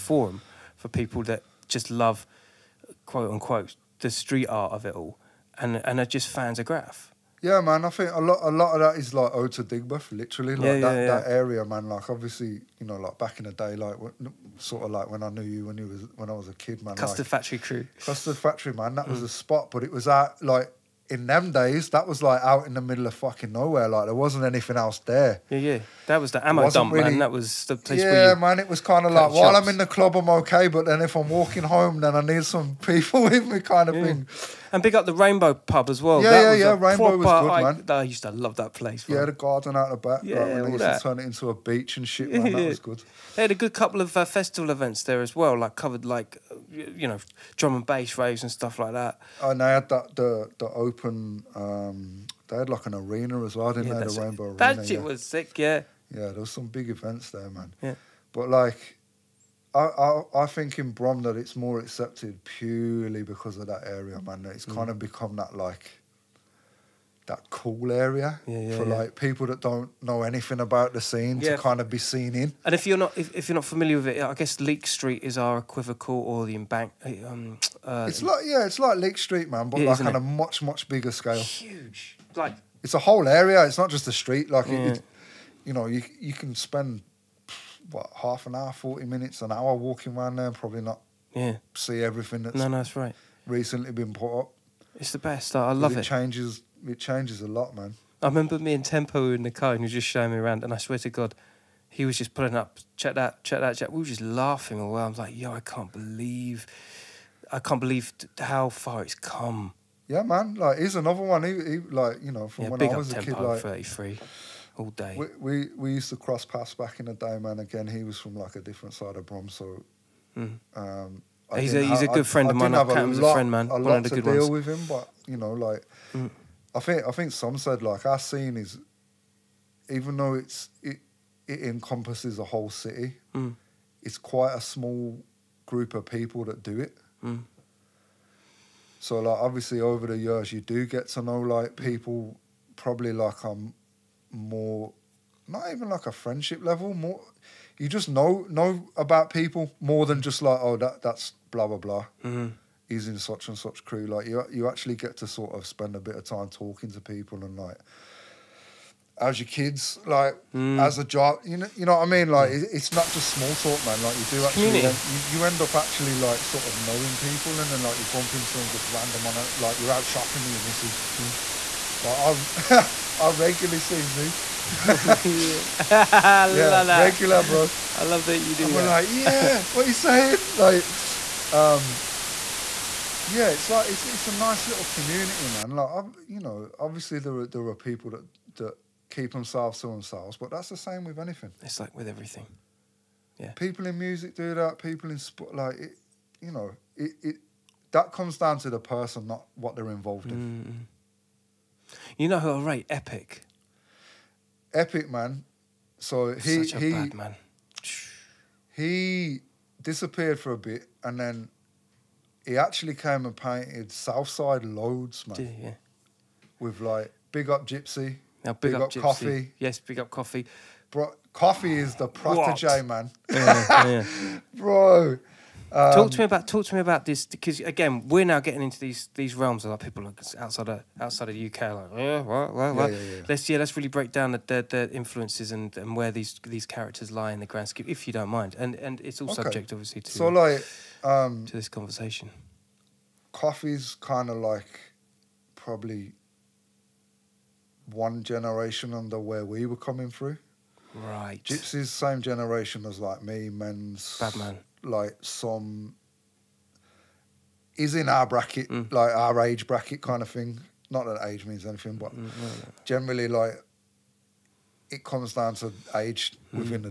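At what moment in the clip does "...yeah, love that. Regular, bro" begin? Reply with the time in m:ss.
2:55.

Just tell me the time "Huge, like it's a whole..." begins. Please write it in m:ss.
1:21.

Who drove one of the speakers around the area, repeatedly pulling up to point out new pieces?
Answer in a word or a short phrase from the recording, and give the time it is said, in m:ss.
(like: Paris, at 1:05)
Tempo, at 1:38.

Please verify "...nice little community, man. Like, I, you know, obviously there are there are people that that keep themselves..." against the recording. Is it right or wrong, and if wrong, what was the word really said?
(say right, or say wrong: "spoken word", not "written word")
right.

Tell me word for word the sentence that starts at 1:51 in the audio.
He, he like you know from yeah, when I was a kid, like thirty three all day.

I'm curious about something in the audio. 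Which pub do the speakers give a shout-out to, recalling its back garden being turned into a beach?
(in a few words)
Rainbow Pub.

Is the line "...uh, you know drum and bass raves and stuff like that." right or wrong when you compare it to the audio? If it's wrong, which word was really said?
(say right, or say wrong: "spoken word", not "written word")
right.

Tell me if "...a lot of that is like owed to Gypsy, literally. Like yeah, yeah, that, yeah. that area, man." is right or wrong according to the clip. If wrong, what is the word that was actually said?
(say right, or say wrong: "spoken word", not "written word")
wrong: "Digbeth", not "Gypsy".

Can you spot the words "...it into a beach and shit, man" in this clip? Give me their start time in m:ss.
0:41.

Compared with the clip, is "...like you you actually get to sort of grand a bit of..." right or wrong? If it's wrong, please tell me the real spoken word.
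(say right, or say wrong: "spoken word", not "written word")
wrong: "spend", not "grand".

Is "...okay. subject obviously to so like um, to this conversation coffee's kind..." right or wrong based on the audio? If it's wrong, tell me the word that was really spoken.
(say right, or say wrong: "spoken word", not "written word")
right.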